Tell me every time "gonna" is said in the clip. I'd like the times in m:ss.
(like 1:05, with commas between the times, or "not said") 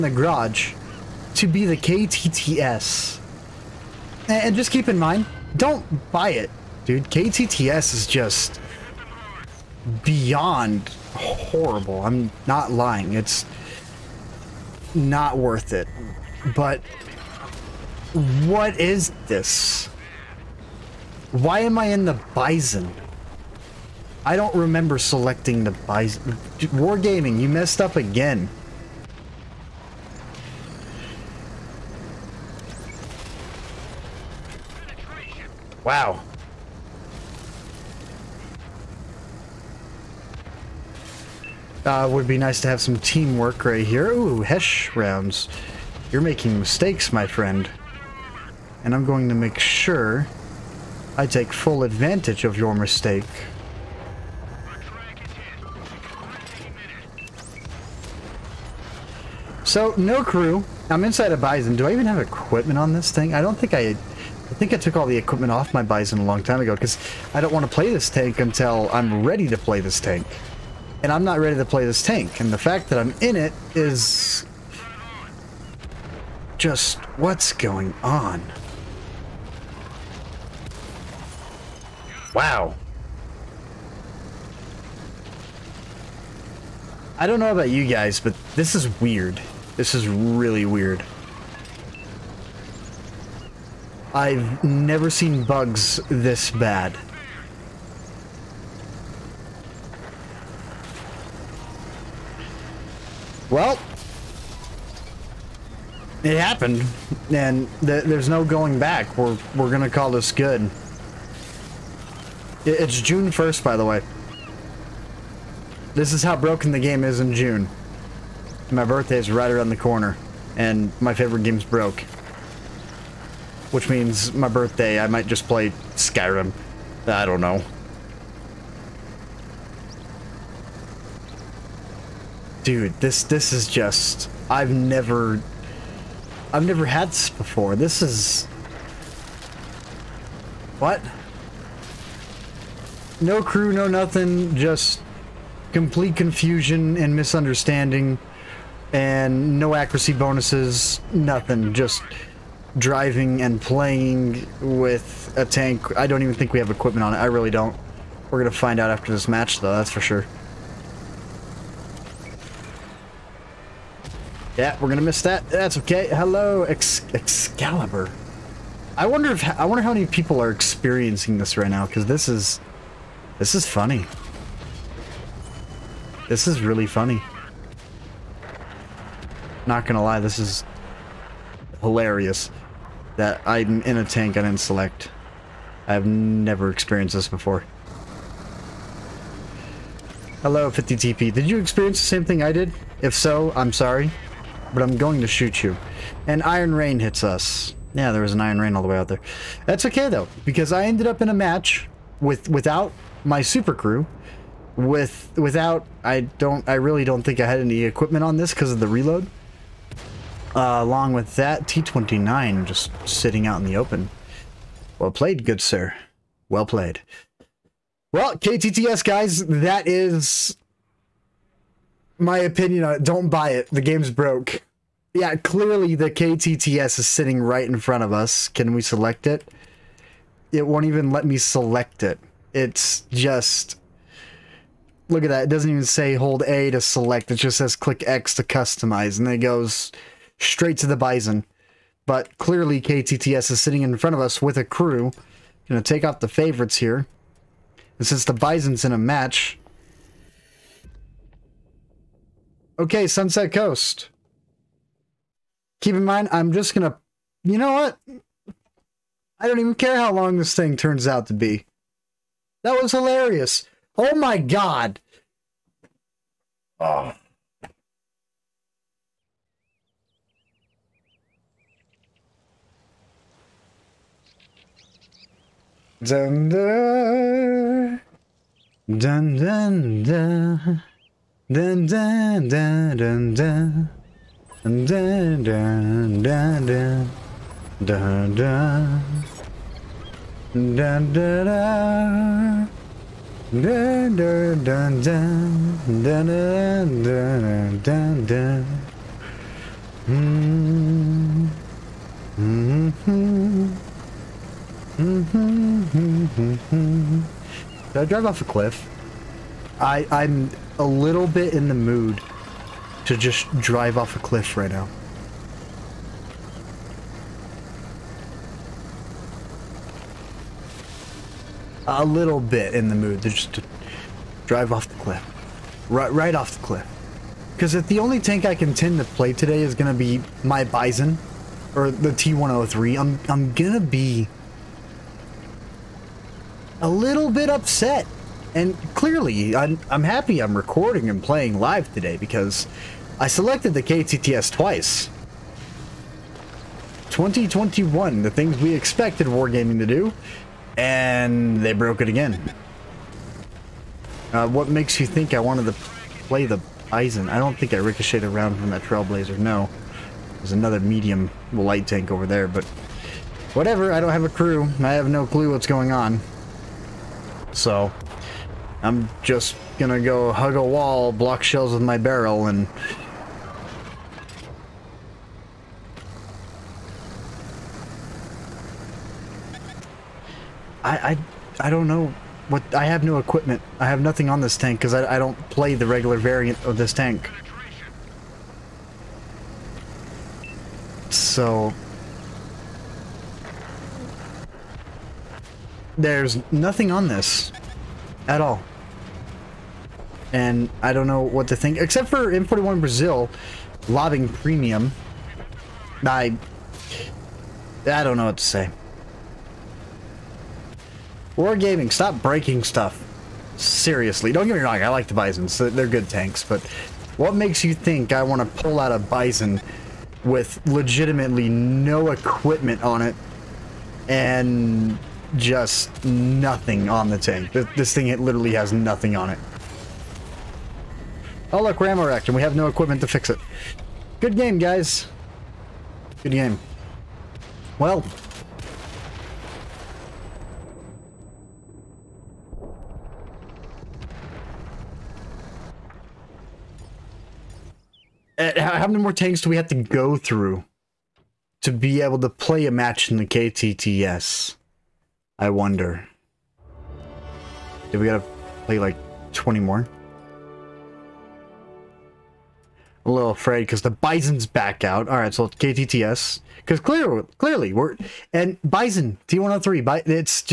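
1:49, 2:59, 4:05, 4:16, 6:09.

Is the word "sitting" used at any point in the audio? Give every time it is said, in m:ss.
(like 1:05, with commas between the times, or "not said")
3:33, 3:47, 4:03.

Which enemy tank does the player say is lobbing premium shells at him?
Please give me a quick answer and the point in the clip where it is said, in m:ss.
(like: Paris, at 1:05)
M41 Brazil, at 6:42.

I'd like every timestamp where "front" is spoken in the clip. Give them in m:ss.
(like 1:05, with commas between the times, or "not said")
3:47, 4:03.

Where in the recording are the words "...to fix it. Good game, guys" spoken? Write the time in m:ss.
7:13.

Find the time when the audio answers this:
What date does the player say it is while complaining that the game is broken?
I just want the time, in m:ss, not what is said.
1:53.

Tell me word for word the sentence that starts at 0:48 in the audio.
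And I'm going to make sure I take full advantage of your mistake.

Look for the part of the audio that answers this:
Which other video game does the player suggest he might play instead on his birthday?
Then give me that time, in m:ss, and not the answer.
2:05.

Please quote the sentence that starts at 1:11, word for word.
And I'm not ready to play this tank.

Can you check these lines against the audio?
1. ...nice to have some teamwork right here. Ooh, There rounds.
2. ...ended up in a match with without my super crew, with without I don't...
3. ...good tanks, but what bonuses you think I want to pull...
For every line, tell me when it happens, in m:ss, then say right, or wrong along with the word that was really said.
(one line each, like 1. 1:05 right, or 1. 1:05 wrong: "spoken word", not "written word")
1. 0:42 wrong: "Hesh", not "There"
2. 3:20 right
3. 6:55 wrong: "makes", not "bonuses".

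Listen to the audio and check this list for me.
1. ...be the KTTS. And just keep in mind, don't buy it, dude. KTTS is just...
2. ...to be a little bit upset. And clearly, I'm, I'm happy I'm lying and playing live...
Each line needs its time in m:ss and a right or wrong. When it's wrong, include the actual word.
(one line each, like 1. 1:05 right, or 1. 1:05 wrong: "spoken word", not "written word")
1. 0:01 right
2. 5:33 wrong: "recording", not "lying".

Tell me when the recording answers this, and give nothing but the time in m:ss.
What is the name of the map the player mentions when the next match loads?
4:13.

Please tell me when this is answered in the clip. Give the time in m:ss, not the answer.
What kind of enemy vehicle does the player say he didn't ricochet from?
5:58.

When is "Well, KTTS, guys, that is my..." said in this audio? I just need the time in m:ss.
3:38.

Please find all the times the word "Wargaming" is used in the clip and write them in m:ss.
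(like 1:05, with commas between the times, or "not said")
0:26, 5:49, 6:51.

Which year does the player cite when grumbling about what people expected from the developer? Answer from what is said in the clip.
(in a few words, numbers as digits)
2021.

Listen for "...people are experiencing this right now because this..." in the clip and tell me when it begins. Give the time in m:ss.
2:50.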